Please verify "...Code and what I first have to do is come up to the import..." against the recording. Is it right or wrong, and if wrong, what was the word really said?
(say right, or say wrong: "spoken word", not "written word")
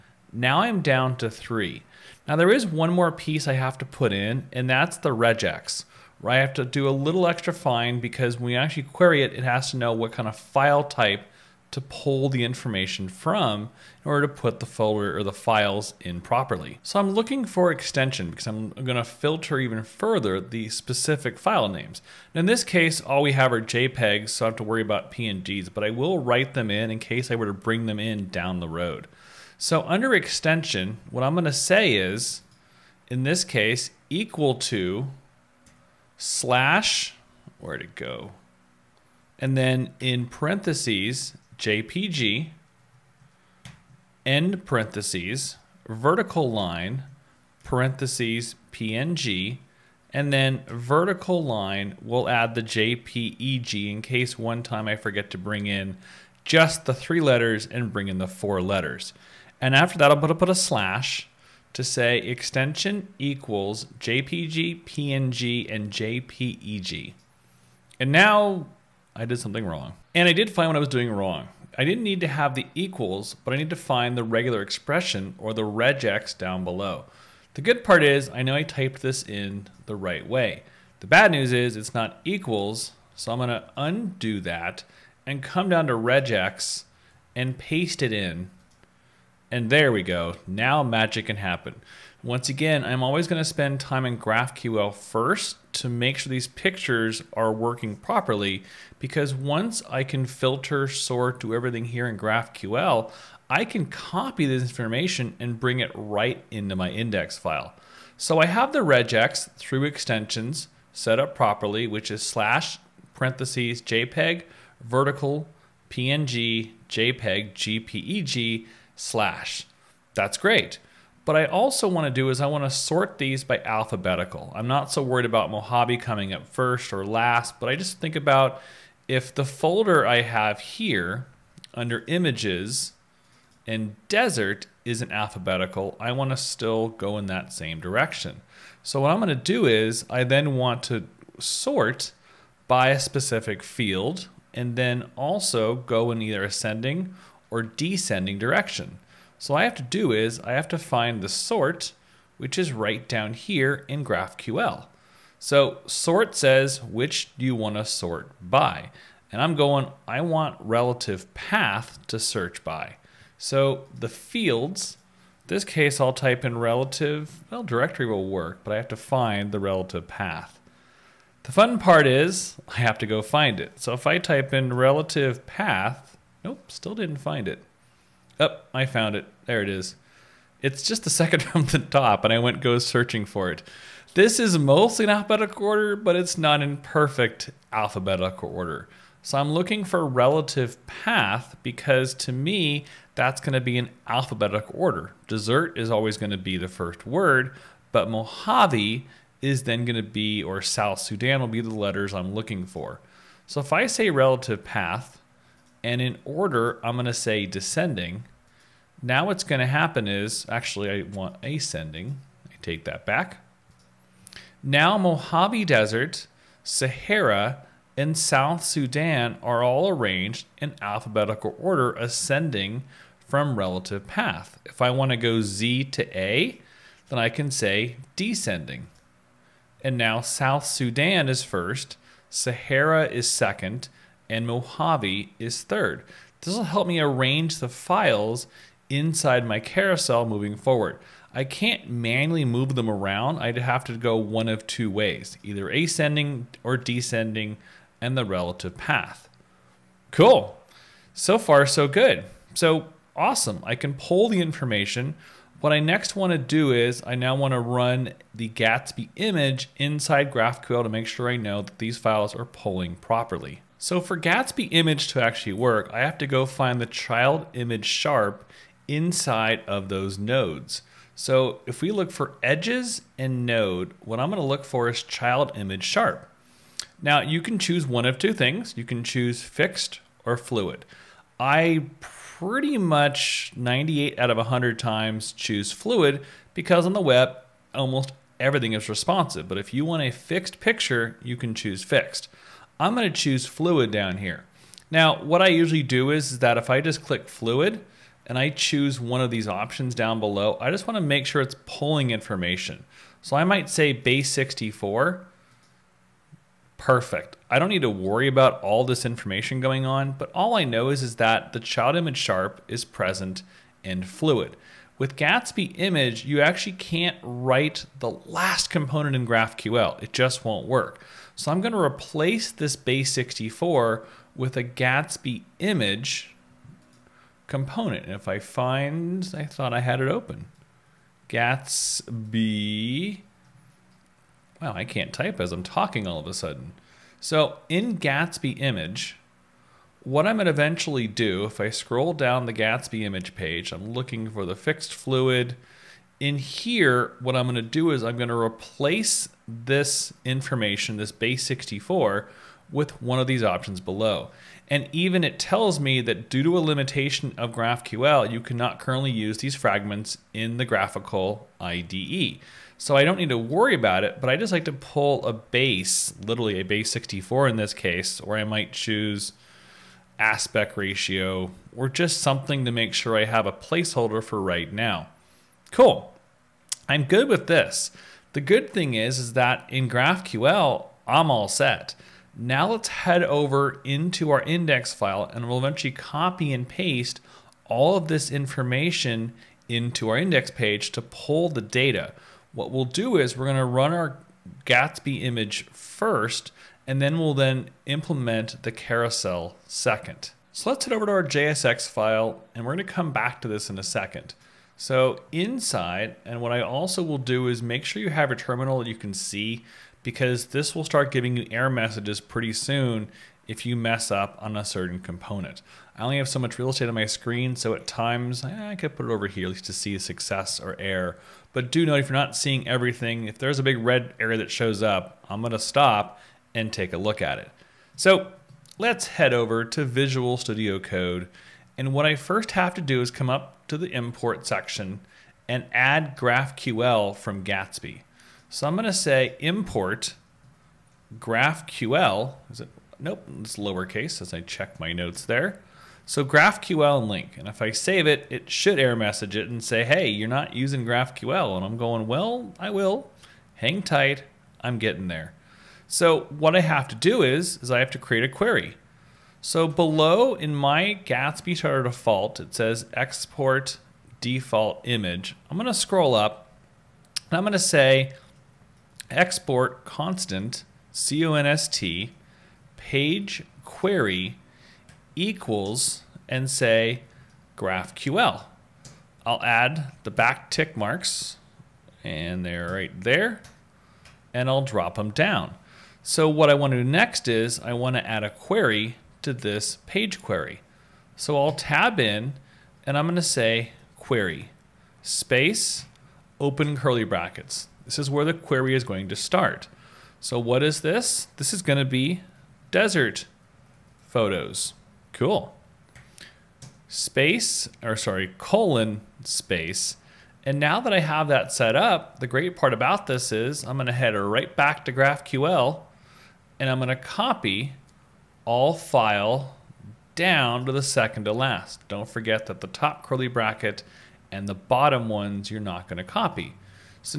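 right.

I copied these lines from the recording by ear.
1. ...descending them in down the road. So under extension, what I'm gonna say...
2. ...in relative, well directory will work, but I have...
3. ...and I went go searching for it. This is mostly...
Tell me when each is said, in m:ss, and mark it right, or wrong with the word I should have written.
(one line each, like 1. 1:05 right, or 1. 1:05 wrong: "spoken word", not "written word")
1. 0:27 wrong: "bring", not "descending"
2. 2:46 right
3. 3:02 right.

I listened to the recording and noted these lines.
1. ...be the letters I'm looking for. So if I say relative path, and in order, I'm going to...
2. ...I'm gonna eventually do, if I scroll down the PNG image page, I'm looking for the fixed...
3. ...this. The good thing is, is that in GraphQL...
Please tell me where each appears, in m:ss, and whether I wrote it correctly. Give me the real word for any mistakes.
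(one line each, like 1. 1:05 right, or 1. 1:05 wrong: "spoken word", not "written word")
1. 3:21 right
2. 5:40 wrong: "Gatsby", not "PNG"
3. 6:17 right.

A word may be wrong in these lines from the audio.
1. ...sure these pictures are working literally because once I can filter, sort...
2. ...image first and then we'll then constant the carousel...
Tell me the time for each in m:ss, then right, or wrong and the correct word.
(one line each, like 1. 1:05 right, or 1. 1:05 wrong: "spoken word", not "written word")
1. 1:36 wrong: "properly", not "literally"
2. 6:35 wrong: "implement", not "constant".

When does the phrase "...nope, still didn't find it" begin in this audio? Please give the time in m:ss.
2:56.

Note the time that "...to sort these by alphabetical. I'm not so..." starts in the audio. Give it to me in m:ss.
2:02.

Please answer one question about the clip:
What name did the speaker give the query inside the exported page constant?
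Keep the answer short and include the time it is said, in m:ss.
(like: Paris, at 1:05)
desert photos, at 8:22.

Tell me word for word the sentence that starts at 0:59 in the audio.
And after that, I'll put a, put a slash to say extension equals JPG, PNG, and JPEG.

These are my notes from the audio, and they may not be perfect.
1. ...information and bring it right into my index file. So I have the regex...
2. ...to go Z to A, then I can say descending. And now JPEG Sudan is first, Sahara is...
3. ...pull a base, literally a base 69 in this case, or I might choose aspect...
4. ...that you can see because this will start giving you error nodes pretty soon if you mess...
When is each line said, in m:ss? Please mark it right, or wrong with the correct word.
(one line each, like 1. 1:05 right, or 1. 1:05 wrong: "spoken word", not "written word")
1. 1:44 right
2. 3:45 wrong: "South", not "JPEG"
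3. 6:04 wrong: "64", not "69"
4. 6:48 wrong: "messages", not "nodes".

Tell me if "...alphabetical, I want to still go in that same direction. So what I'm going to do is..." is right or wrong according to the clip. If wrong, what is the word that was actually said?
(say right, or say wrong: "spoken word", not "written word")
right.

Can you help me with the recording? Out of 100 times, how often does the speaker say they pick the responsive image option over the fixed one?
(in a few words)
98.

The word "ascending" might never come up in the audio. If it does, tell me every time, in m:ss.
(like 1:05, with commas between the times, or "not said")
2:26, 3:31, 3:41, 4:05.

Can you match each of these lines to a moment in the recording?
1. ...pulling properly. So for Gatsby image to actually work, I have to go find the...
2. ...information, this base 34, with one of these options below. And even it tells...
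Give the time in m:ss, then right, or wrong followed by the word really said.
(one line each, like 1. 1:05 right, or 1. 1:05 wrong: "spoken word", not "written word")
1. 4:22 right
2. 5:50 wrong: "64", not "34".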